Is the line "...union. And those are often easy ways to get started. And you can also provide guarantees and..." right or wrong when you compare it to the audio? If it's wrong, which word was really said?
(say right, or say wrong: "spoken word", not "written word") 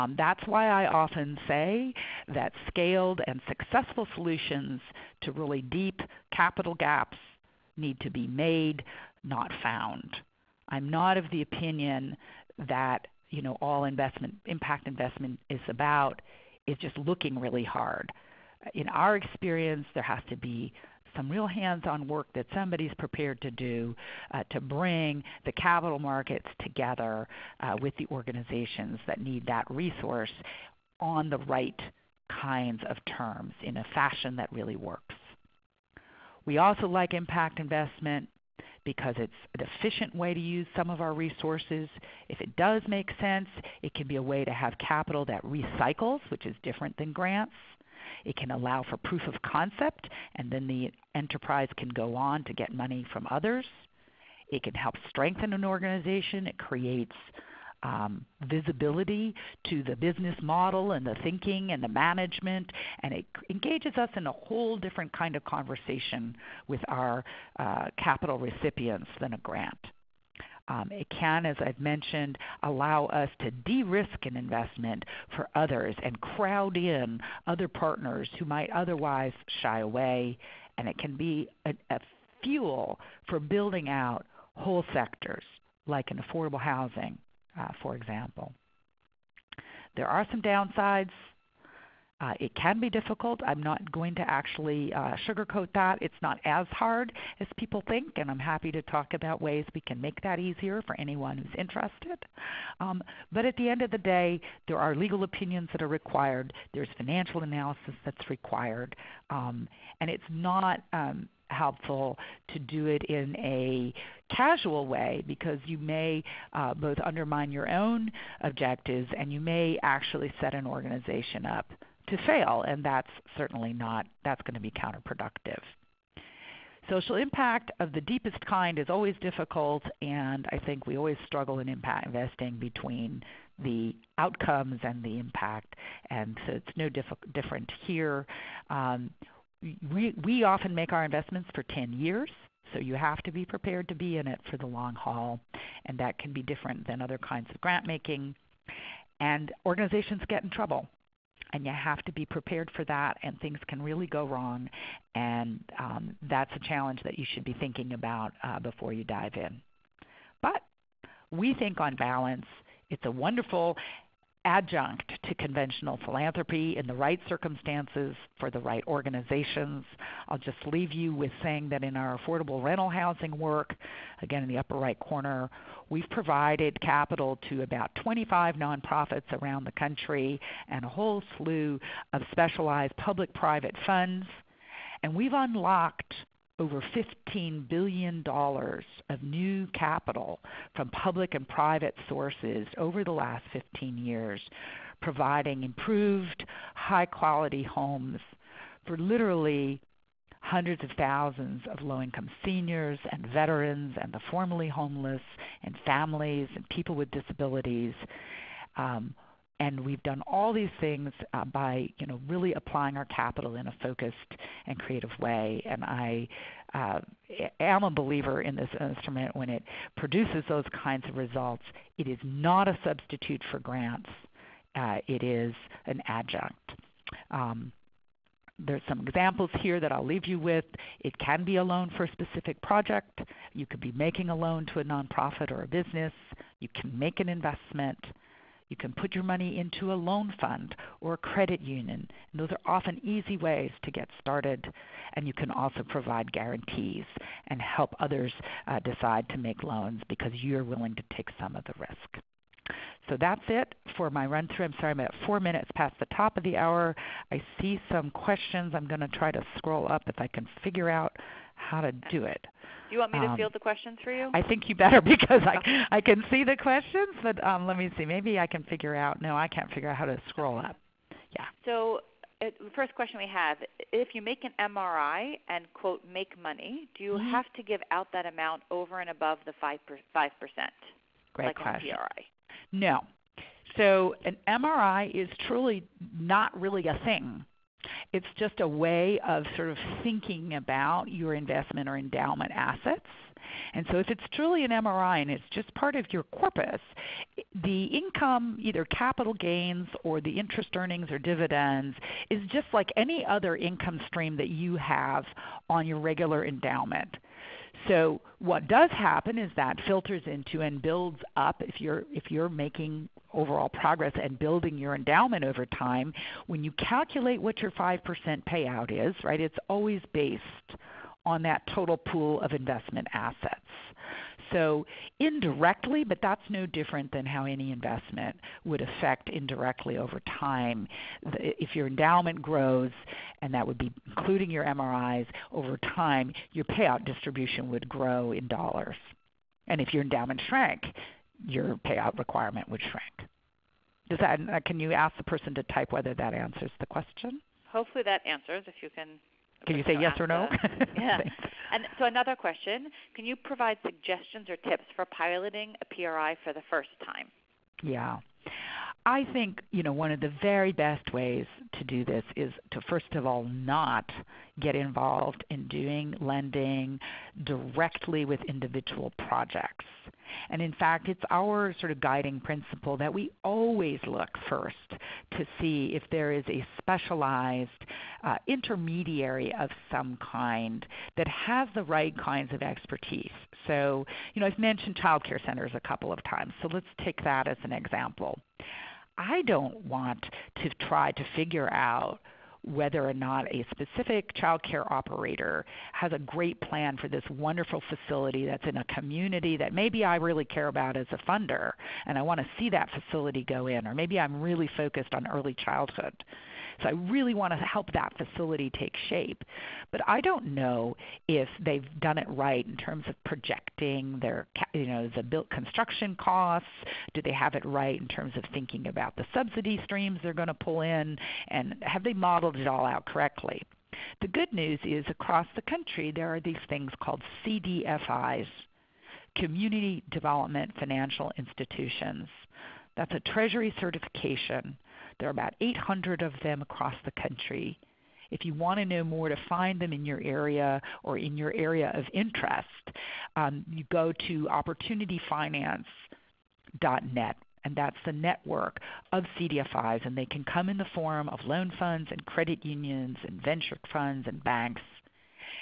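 right.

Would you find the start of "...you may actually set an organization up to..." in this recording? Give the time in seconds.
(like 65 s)
119 s.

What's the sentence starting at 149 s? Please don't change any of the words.
And organizations get in trouble and you have to be prepared for that, and things can really go wrong.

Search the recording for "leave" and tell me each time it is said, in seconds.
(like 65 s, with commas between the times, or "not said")
170 s, 230 s.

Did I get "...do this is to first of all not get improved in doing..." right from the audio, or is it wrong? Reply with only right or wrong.
wrong.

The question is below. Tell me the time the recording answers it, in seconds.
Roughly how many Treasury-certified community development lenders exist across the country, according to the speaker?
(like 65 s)
435 s.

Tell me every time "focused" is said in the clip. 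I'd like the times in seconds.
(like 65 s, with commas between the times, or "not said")
213 s, 404 s.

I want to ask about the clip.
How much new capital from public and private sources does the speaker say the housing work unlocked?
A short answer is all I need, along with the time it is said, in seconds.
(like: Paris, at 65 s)
$15 billion, at 187 s.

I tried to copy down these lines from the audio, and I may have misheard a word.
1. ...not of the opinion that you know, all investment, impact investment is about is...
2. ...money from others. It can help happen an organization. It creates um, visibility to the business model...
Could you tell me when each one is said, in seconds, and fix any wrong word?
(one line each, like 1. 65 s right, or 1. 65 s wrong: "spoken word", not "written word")
1. 10 s right
2. 52 s wrong: "strengthen", not "happen".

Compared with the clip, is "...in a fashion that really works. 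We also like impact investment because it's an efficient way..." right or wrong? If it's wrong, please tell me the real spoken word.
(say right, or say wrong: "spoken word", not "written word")
right.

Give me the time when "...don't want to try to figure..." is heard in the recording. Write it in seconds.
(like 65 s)
389 s.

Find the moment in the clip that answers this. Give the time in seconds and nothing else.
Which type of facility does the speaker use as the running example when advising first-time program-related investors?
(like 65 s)
384 s.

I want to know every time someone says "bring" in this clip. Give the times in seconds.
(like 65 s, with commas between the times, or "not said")
24 s.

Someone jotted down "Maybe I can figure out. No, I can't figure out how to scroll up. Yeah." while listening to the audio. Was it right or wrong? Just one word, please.
right.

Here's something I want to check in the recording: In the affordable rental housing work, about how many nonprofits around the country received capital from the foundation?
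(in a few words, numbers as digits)
25.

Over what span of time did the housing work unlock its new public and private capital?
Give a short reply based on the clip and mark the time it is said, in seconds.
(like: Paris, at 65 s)
15 years, at 193 s.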